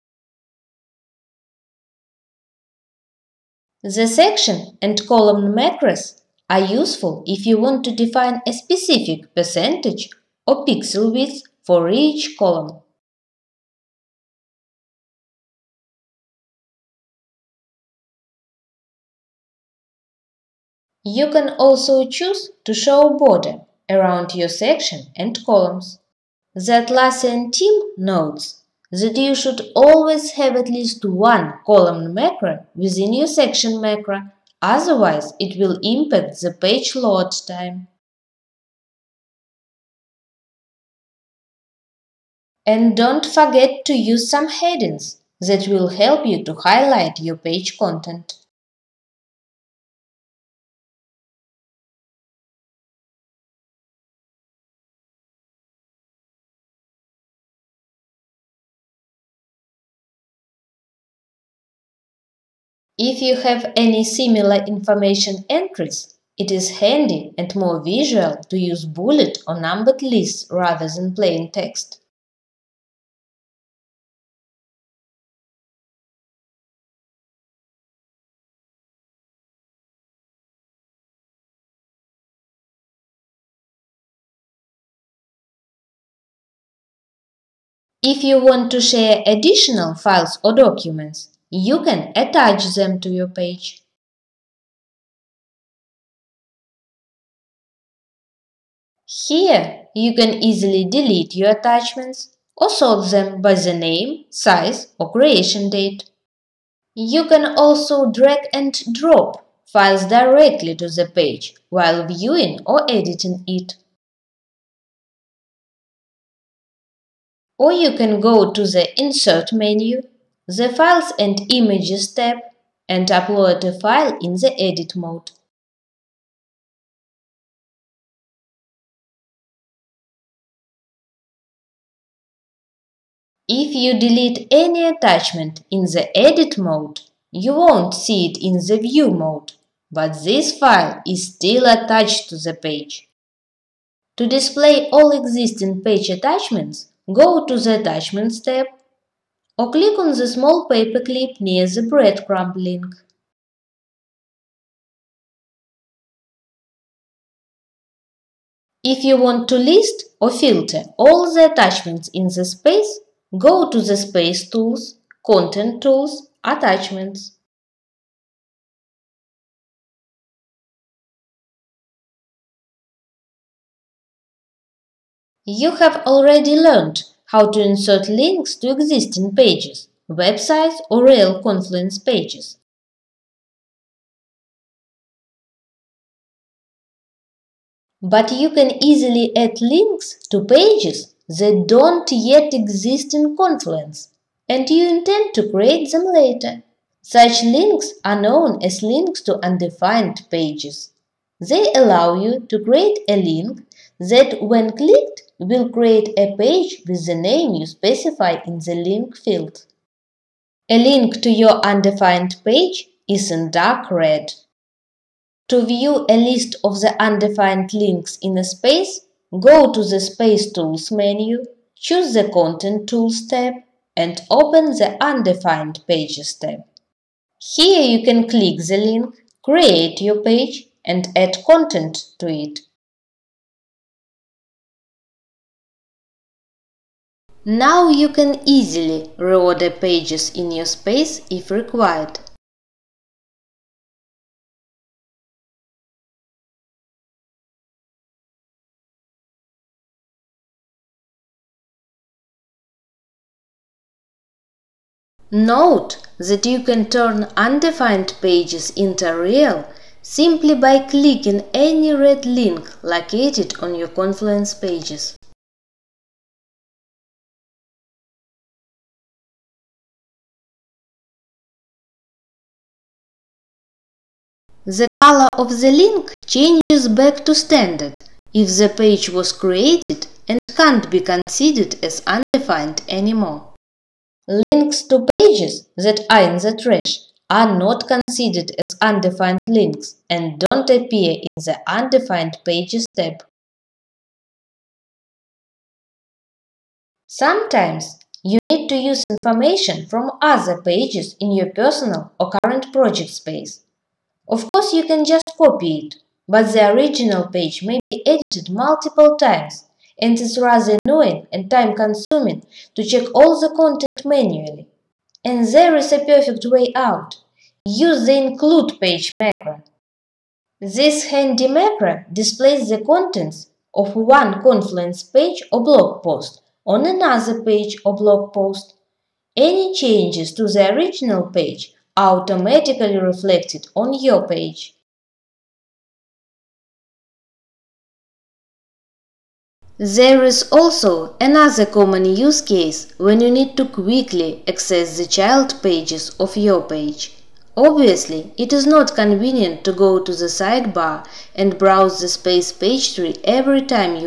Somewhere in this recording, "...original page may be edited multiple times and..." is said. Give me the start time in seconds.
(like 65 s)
306 s.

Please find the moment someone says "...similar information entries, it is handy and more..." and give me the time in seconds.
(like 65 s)
64 s.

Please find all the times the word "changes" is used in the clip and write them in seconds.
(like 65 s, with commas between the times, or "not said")
276 s, 329 s.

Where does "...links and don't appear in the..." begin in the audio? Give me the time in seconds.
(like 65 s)
289 s.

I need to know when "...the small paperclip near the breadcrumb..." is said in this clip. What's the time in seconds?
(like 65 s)
150 s.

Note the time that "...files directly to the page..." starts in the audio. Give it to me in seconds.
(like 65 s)
109 s.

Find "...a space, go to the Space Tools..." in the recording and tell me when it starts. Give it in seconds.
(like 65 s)
218 s.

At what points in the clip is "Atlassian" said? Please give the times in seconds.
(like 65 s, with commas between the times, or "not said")
26 s.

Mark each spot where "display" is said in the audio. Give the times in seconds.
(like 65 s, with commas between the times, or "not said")
144 s, 322 s.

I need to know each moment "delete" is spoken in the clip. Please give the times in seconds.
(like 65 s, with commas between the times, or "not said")
100 s, 133 s.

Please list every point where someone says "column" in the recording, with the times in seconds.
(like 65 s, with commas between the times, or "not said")
5 s, 12 s, 25 s, 31 s.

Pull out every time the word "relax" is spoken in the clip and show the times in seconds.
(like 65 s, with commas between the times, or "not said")
not said.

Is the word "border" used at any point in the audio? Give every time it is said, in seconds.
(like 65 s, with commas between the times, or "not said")
23 s.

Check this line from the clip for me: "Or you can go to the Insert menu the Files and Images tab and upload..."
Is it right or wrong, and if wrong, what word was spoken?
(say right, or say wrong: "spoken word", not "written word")
right.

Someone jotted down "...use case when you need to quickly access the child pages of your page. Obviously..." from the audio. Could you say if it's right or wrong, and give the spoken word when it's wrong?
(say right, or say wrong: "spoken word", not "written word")
right.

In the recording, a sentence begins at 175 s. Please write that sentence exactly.
You have already learned how to insert links to existing pages, websites or real Confluence pages.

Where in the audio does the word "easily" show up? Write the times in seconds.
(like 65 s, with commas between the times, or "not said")
100 s, 188 s, 238 s.